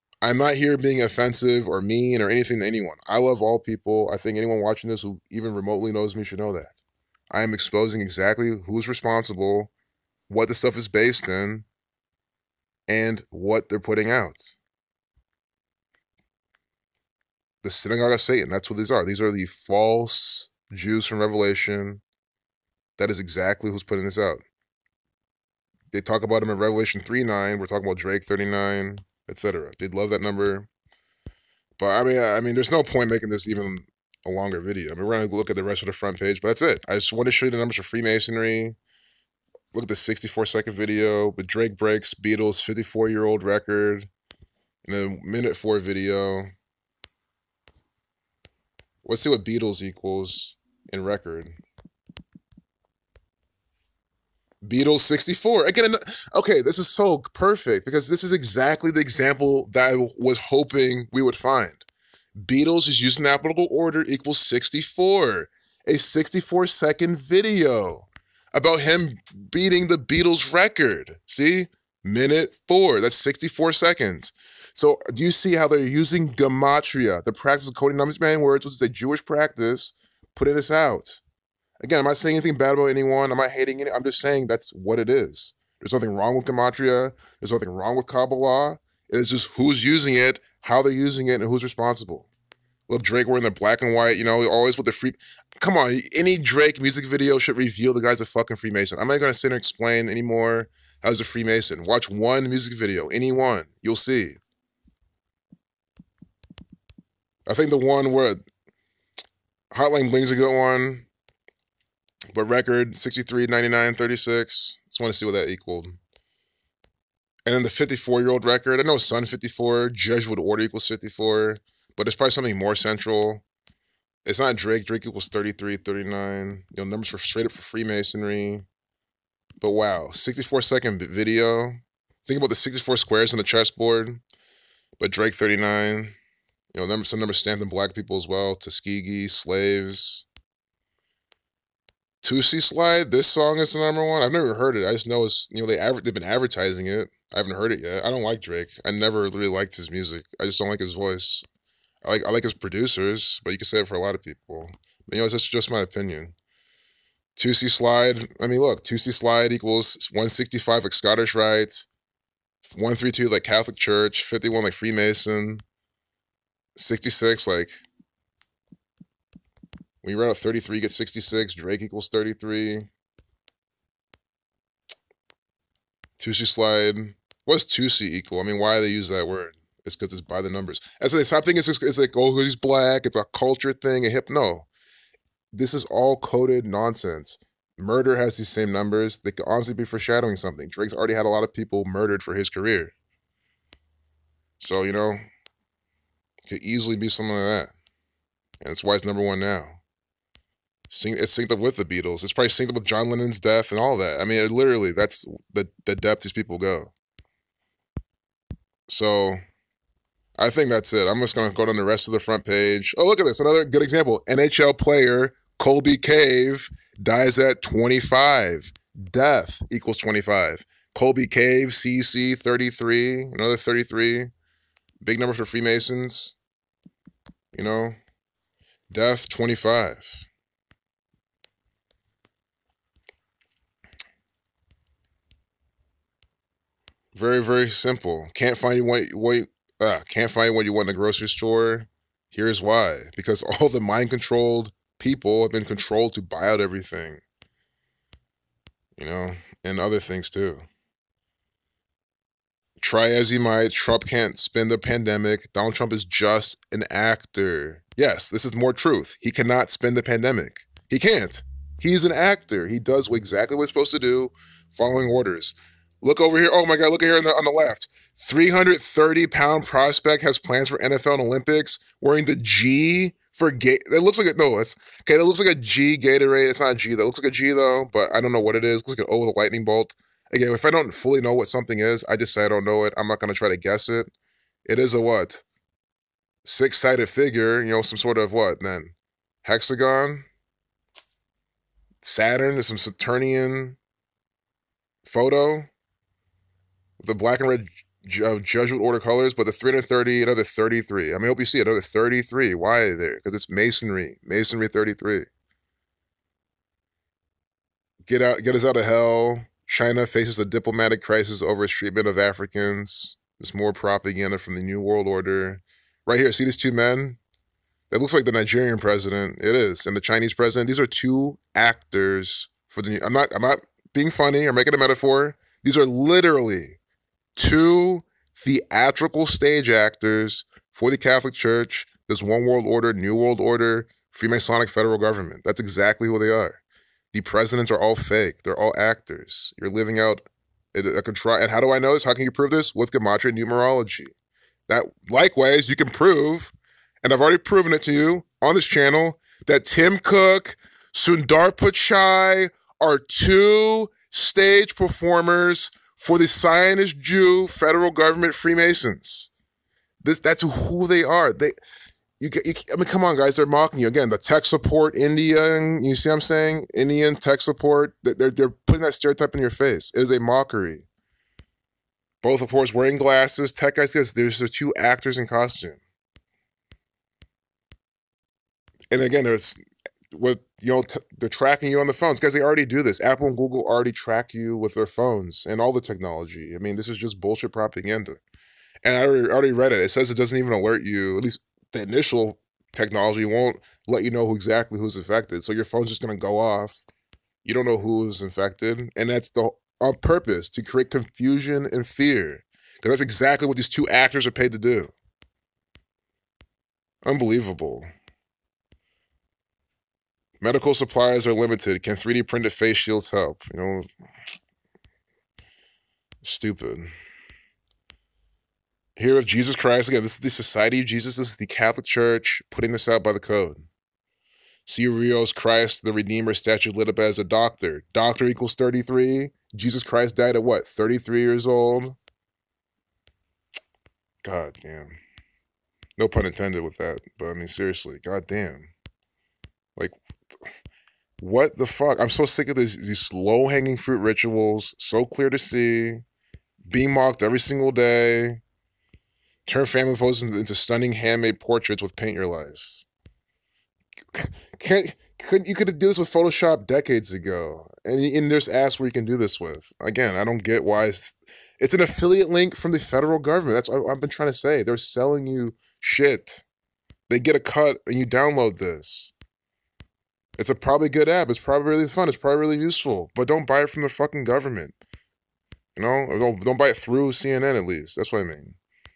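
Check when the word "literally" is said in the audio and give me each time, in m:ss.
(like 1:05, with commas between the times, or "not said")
3:24, 5:25.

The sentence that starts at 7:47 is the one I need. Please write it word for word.
They get a cut and you download this.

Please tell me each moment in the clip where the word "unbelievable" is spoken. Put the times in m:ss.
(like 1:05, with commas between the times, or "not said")
6:47.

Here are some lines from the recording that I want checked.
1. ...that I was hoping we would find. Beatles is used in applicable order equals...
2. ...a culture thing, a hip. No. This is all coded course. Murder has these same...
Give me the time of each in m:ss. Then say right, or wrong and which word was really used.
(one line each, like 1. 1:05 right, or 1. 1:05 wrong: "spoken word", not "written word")
1. 0:59 right
2. 3:03 wrong: "nonsense", not "course".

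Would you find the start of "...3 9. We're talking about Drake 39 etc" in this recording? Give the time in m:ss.
0:27.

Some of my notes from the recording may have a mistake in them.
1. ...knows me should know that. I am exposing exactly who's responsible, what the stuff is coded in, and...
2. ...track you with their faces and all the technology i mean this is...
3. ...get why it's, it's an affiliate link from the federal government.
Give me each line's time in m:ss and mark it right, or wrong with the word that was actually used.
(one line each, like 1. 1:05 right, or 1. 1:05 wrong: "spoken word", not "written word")
1. 0:05 wrong: "based", not "coded"
2. 6:23 wrong: "phones", not "faces"
3. 7:40 right.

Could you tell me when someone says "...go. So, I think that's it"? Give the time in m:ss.
3:26.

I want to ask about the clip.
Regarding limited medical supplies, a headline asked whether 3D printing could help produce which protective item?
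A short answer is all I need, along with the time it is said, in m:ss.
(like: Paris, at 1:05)
Face shields, at 6:52.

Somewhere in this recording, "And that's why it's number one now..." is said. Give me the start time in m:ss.
3:18.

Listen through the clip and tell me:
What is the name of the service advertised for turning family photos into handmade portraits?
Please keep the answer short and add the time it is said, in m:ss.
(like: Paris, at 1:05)
Paint Your Life, at 7:31.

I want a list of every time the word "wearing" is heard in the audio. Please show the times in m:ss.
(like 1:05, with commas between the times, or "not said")
1:33, 4:31, 6:12.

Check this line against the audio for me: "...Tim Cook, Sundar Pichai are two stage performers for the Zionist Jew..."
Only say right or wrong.
right.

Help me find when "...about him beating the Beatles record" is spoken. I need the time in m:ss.
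1:08.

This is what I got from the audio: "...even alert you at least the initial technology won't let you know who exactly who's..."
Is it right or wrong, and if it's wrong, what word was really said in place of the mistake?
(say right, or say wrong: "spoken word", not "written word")
right.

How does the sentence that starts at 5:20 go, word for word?
These are two actors for the.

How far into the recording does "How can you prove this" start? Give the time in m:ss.
5:42.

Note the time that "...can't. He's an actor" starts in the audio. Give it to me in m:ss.
4:20.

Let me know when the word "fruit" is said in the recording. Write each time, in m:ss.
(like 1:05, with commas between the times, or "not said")
7:23.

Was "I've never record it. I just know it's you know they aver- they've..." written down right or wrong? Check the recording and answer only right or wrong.
wrong.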